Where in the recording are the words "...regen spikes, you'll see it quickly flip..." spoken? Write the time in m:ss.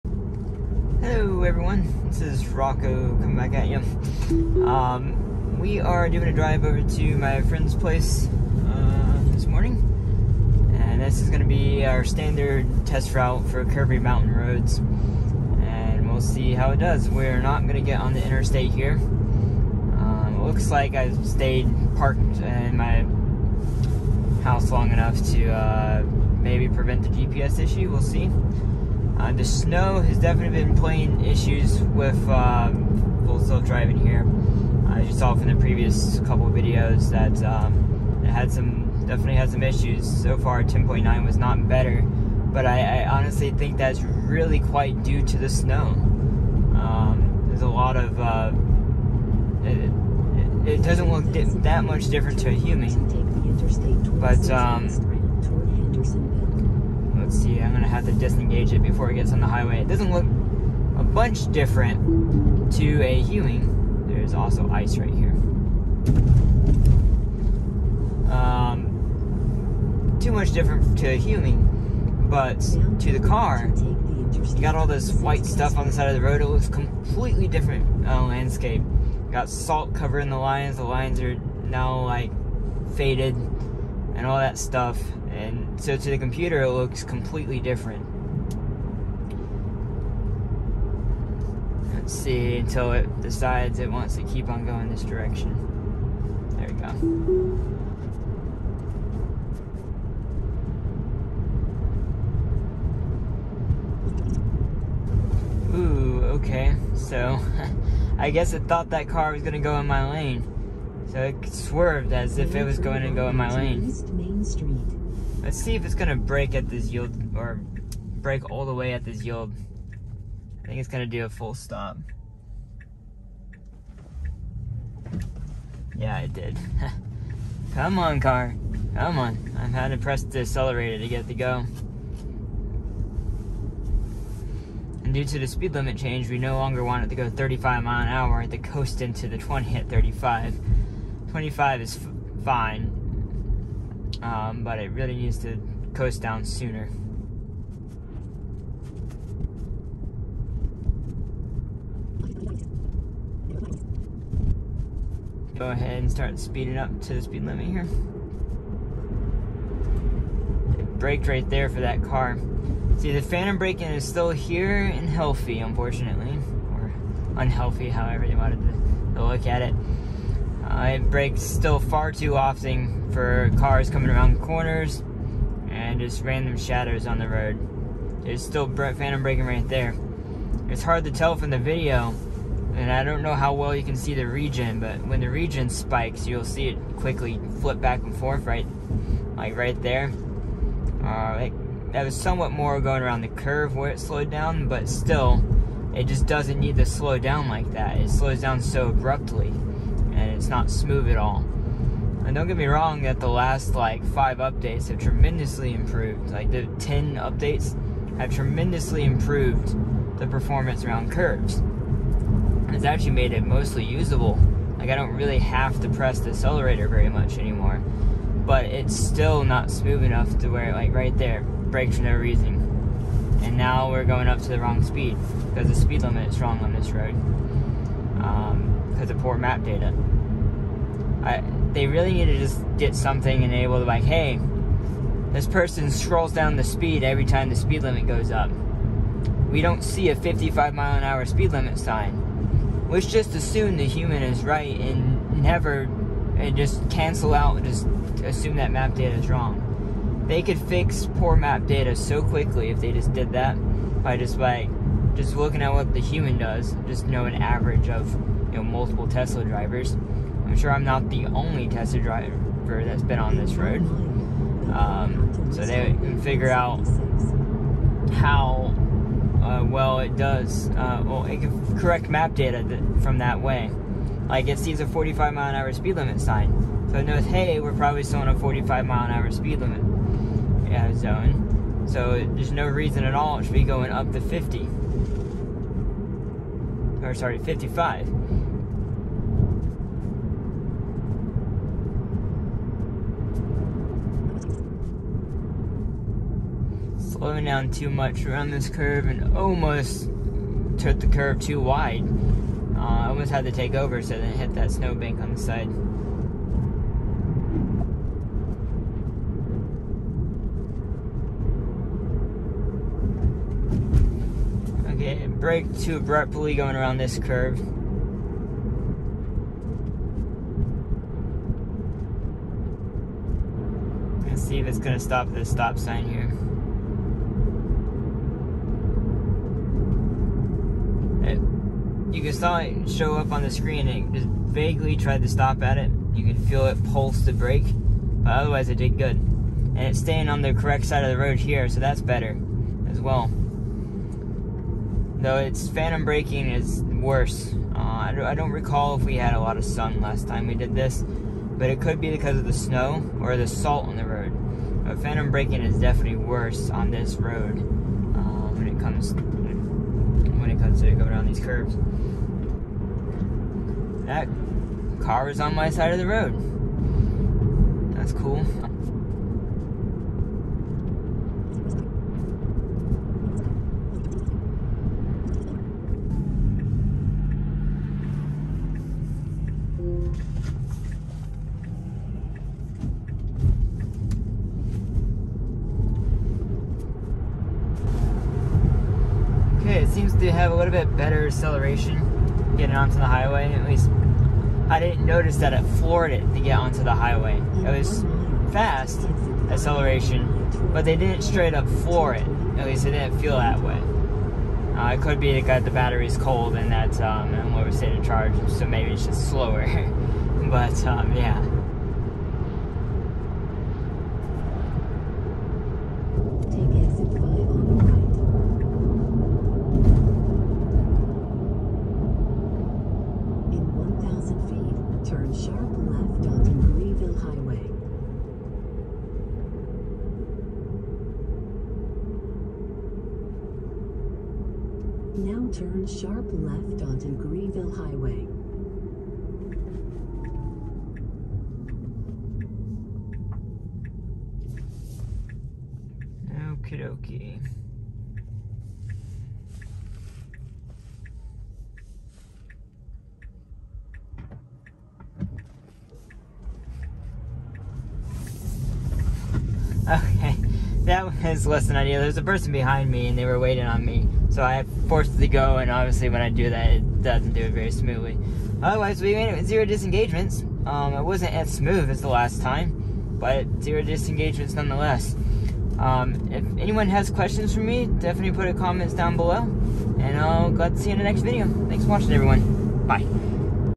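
3:05.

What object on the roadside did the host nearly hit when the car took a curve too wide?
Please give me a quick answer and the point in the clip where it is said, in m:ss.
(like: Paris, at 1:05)
snowbank, at 5:04.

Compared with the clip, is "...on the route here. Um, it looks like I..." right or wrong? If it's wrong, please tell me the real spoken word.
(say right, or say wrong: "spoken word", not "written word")
wrong: "interstate", not "route".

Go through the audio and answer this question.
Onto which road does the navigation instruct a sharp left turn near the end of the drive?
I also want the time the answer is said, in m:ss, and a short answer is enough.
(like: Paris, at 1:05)
Greenville Highway, at 7:17.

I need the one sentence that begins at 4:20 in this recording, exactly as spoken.
I'm sure I'm not the only Tesla driver that's been on this road.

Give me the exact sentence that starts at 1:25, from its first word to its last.
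And so to the computer, it looks completely different.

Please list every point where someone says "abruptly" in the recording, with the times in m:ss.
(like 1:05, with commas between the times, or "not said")
3:18, 5:15.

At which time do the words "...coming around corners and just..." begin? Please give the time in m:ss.
2:53.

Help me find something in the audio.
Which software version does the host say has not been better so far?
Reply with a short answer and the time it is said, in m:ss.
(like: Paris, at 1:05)
10.9, at 0:40.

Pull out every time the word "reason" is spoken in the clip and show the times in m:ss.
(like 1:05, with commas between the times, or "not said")
3:42, 4:42.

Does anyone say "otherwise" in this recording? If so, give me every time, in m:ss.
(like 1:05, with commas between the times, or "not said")
5:38, 7:48.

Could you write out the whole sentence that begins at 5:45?
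Though its phantom braking is worse.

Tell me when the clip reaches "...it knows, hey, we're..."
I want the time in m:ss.
4:36.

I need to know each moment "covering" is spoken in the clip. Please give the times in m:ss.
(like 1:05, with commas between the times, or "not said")
1:19.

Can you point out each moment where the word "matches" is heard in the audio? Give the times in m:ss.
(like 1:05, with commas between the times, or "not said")
not said.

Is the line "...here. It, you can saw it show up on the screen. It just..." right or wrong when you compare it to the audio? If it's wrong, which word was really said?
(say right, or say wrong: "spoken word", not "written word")
right.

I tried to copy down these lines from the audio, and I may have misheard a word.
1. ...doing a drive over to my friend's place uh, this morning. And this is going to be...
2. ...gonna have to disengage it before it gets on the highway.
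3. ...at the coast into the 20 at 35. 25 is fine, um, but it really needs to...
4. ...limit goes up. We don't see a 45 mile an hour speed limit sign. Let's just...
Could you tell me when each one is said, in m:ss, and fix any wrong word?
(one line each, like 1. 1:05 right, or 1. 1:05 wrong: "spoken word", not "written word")
1. 0:06 right
2. 0:57 right
3. 2:18 right
4. 3:57 wrong: "55", not "45".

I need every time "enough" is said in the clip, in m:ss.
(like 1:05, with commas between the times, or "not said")
0:24, 3:40.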